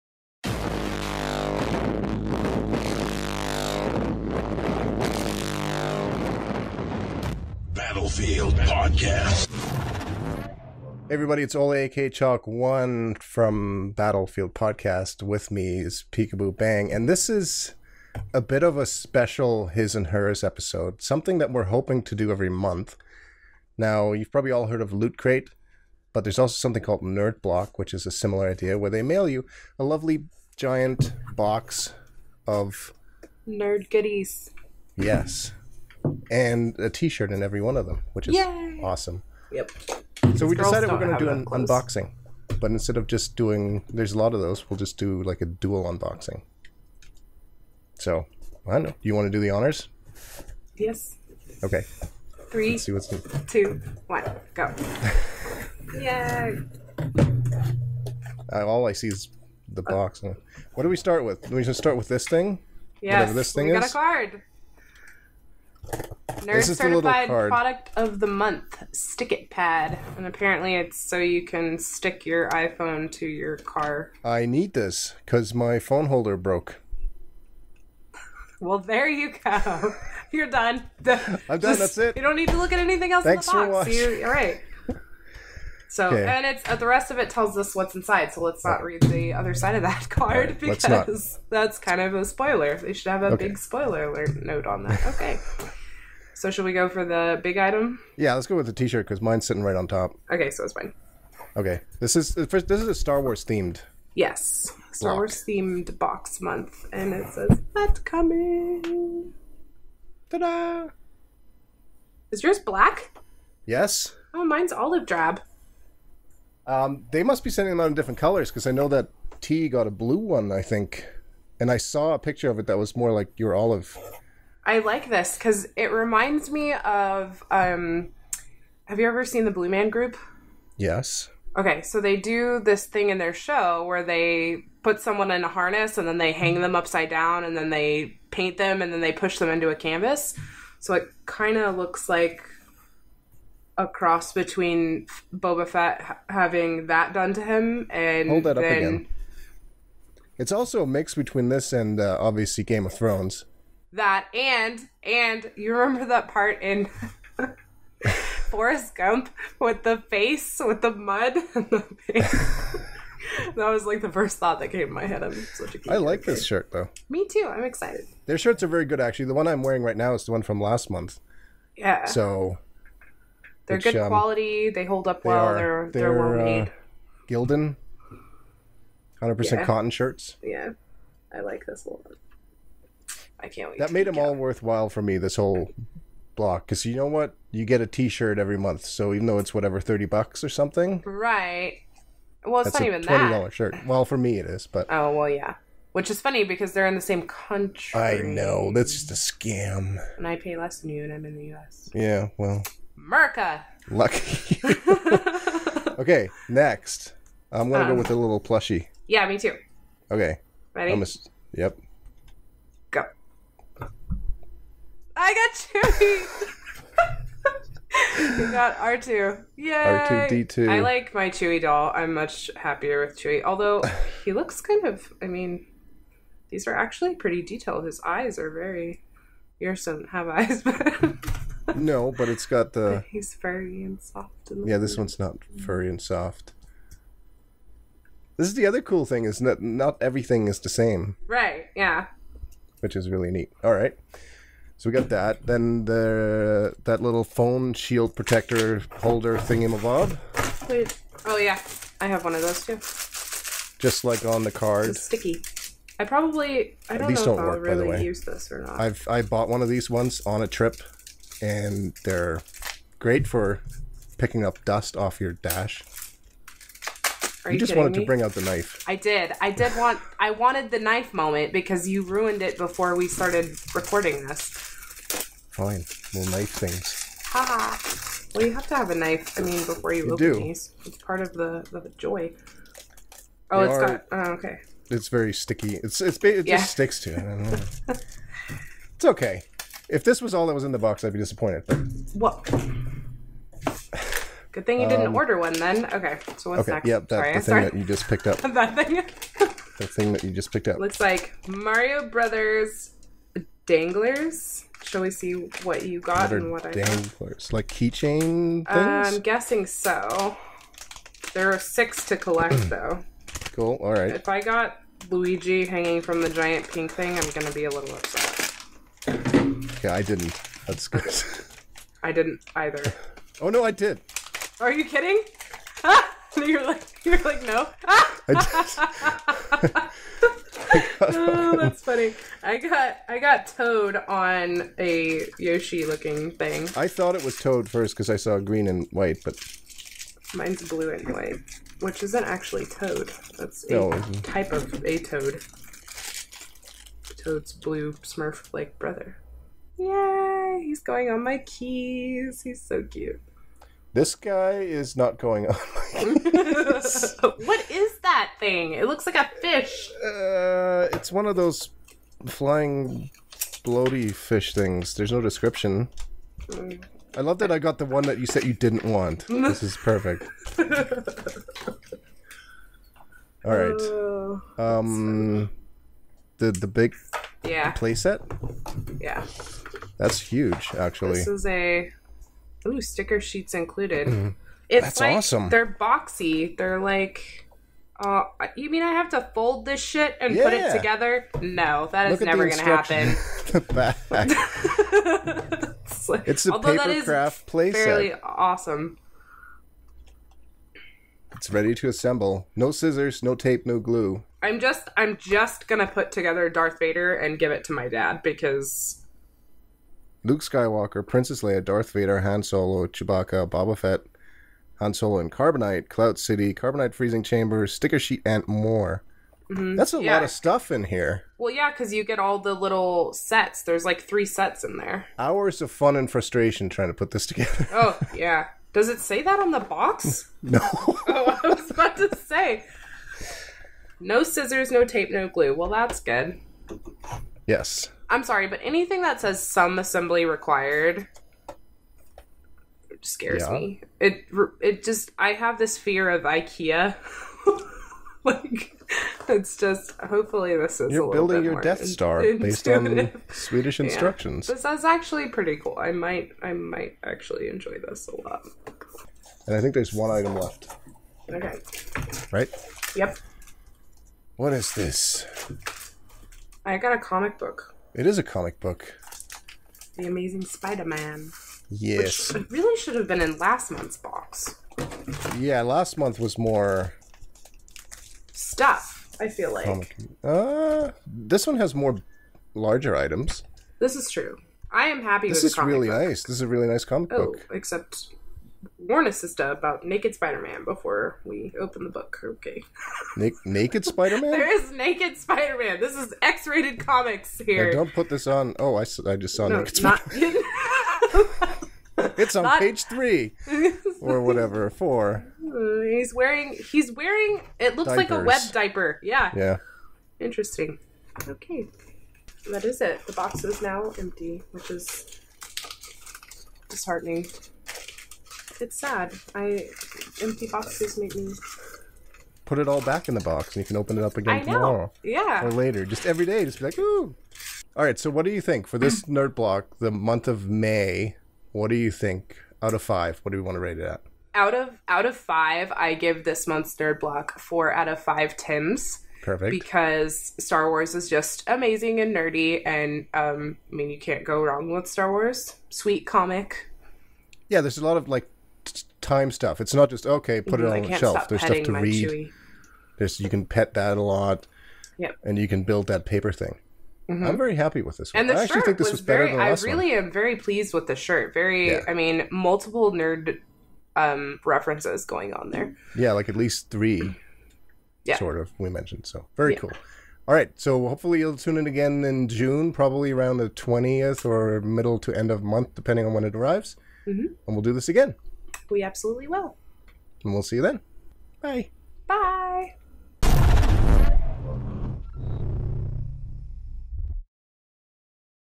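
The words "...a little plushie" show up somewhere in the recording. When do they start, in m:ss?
3:28.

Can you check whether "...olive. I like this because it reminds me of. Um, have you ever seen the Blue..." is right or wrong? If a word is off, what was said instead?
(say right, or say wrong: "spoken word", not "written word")
right.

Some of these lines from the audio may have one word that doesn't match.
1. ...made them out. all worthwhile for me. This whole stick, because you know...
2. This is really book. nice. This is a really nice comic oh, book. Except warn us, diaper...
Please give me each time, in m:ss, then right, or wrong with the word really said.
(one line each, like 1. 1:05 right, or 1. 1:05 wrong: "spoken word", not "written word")
1. 3:03 wrong: "block", not "stick"
2. 8:05 wrong: "sister", not "diaper".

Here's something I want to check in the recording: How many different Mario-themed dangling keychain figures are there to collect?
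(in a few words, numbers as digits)
6.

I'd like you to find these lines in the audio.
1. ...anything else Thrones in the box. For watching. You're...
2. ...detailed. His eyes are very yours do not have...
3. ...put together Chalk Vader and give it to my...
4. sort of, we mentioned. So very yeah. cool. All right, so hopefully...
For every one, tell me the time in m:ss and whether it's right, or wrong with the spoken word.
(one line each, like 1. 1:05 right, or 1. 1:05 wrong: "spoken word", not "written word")
1. 1:22 wrong: "Thanks", not "Thrones"
2. 3:47 right
3. 6:45 wrong: "Darth", not "Chalk"
4. 9:28 right.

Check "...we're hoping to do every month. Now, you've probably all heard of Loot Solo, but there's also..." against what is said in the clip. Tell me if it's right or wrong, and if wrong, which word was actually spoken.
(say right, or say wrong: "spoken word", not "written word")
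wrong: "Crate", not "Solo".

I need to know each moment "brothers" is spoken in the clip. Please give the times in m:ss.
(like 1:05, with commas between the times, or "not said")
5:02, 5:48.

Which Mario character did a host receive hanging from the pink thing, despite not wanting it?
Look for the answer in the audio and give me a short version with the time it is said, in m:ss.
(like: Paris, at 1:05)
Luigi, at 5:15.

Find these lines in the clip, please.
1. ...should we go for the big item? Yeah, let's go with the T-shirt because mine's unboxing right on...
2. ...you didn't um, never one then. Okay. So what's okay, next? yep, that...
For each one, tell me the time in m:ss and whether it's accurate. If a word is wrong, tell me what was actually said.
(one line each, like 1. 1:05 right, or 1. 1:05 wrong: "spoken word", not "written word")
1. 1:36 wrong: "sitting", not "unboxing"
2. 4:54 wrong: "order", not "never".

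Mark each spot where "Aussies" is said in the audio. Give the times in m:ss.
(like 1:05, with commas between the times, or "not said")
not said.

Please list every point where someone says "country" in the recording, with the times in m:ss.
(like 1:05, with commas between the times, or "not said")
3:17.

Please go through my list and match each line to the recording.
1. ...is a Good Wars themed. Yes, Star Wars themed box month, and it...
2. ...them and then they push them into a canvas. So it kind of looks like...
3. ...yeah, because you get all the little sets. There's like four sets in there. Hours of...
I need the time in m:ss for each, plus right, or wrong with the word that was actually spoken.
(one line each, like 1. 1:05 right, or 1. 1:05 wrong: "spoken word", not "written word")
1. 1:42 wrong: "Star", not "Good"
2. 2:18 right
3. 7:01 wrong: "three", not "four".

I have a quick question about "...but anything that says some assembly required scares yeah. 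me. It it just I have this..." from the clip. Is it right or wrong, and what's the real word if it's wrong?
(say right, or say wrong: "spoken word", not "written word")
right.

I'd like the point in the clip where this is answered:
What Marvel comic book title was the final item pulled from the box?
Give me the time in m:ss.
7:49.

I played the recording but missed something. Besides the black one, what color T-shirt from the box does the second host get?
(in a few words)
Olive drab.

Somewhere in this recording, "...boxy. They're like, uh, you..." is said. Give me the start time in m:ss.
6:25.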